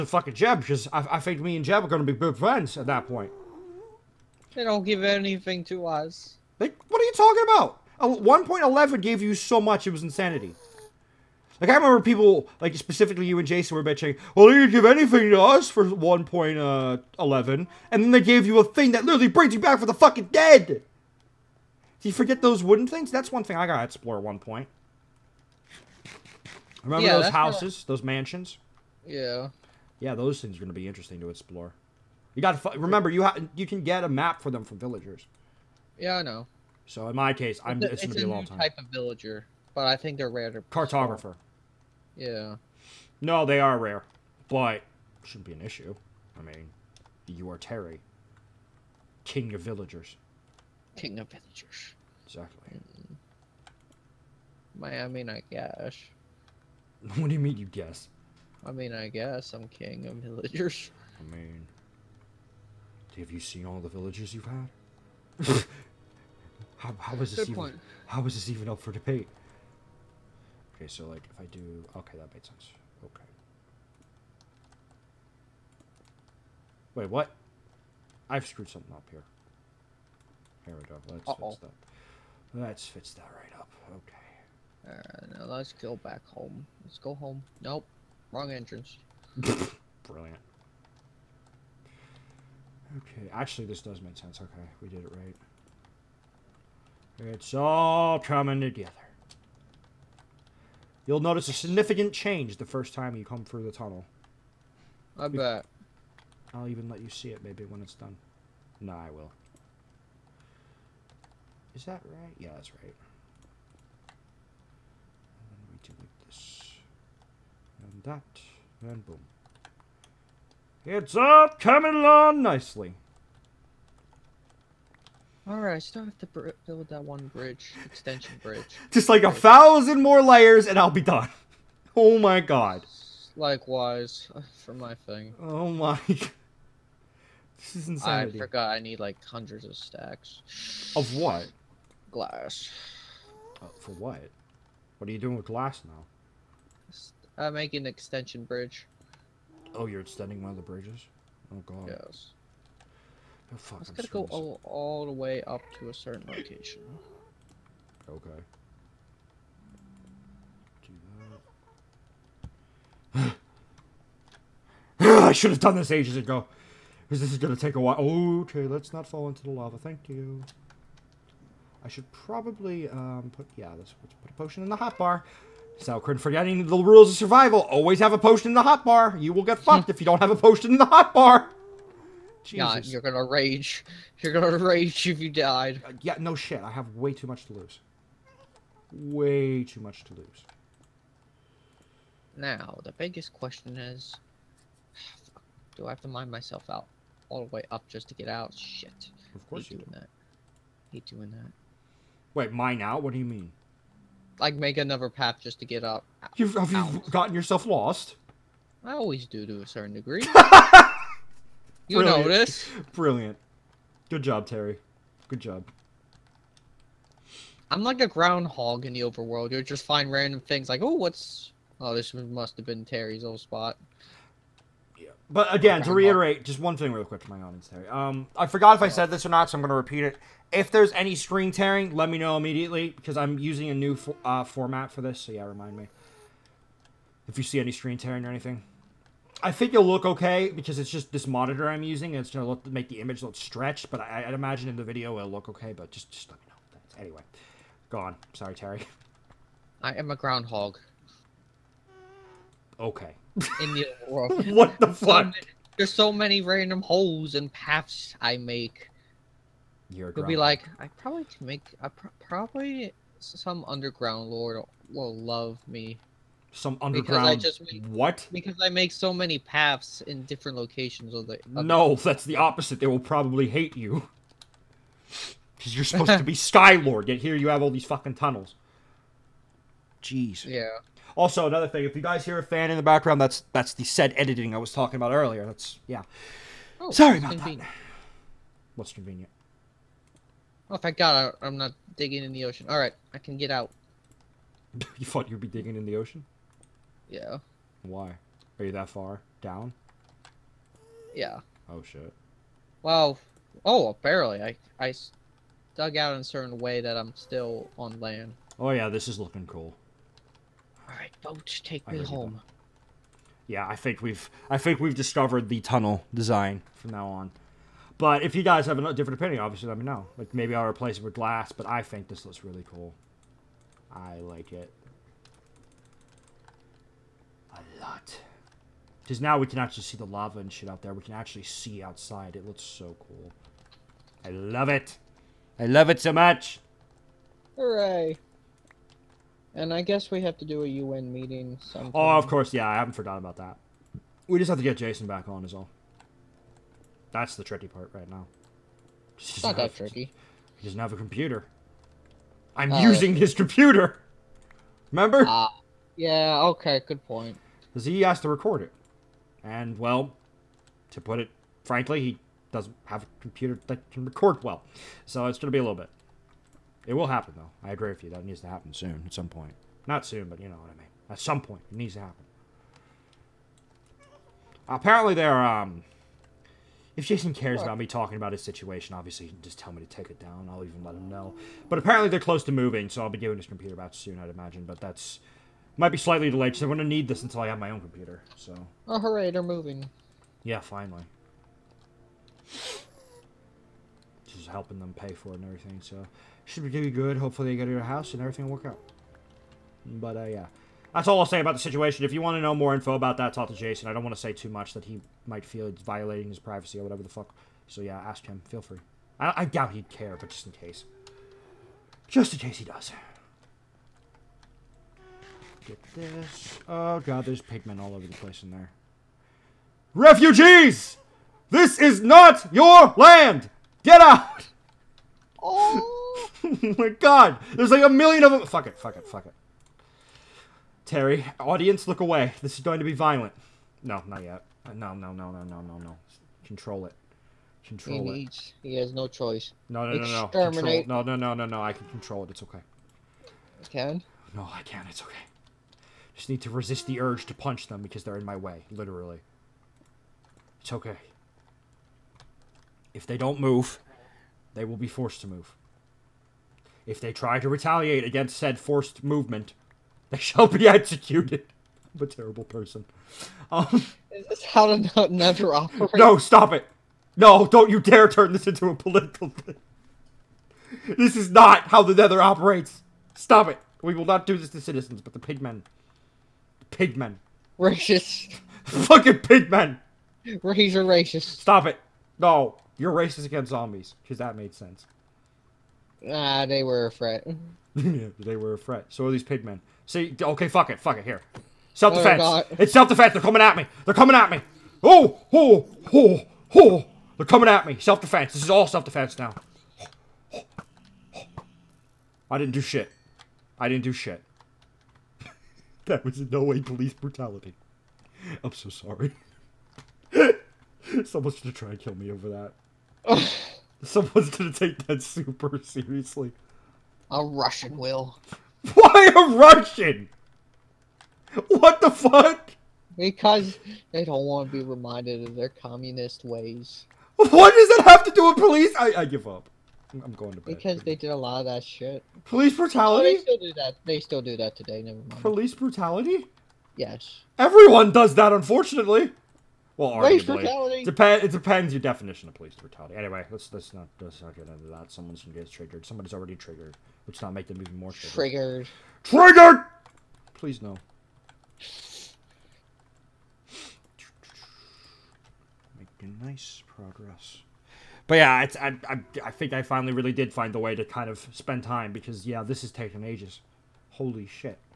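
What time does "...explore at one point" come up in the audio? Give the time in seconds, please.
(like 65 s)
23 s.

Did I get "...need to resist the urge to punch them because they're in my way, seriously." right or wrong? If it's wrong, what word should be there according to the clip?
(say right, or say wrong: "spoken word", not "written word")
wrong: "literally", not "seriously".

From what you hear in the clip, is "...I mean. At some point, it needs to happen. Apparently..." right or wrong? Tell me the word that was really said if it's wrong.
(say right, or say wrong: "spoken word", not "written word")
right.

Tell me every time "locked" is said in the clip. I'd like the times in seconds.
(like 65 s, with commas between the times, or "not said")
not said.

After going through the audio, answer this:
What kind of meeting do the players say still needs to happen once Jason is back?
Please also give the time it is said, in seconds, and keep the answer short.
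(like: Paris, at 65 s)
UN meeting, at 340 s.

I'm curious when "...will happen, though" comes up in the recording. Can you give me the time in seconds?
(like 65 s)
366 s.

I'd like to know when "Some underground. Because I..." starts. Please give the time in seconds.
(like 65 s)
266 s.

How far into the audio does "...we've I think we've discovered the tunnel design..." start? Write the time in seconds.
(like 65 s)
314 s.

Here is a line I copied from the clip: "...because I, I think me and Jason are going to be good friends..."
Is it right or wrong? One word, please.
wrong.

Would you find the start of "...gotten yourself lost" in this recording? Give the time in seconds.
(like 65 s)
207 s.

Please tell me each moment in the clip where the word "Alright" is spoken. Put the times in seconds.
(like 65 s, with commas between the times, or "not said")
84 s, 125 s, 311 s.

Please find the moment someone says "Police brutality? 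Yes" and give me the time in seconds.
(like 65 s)
535 s.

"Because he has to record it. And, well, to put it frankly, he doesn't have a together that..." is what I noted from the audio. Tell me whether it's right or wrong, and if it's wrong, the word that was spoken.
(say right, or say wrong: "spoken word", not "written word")
wrong: "computer", not "together".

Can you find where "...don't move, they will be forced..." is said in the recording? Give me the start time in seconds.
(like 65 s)
453 s.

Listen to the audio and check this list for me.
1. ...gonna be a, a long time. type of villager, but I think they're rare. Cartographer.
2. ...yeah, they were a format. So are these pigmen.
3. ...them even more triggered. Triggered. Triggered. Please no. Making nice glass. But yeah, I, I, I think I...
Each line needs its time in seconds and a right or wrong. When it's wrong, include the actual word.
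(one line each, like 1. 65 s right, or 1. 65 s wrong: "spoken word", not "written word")
1. 38 s right
2. 487 s wrong: "threat", not "format"
3. 547 s wrong: "progress", not "glass".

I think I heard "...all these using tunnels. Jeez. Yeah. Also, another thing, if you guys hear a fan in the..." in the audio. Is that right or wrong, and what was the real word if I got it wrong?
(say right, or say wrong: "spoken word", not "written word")
wrong: "fucking", not "using".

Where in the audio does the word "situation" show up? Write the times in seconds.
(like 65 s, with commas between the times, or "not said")
378 s, 401 s.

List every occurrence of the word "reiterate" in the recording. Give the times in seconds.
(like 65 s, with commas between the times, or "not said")
225 s.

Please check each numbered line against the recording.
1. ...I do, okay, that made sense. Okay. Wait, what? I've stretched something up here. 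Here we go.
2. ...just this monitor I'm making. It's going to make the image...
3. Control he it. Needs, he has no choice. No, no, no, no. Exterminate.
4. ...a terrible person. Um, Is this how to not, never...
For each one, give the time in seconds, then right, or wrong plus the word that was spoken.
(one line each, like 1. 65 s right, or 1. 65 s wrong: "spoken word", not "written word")
1. 71 s wrong: "screwed", not "stretched"
2. 240 s wrong: "using", not "making"
3. 437 s right
4. 462 s right.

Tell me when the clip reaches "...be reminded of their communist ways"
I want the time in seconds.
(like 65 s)
524 s.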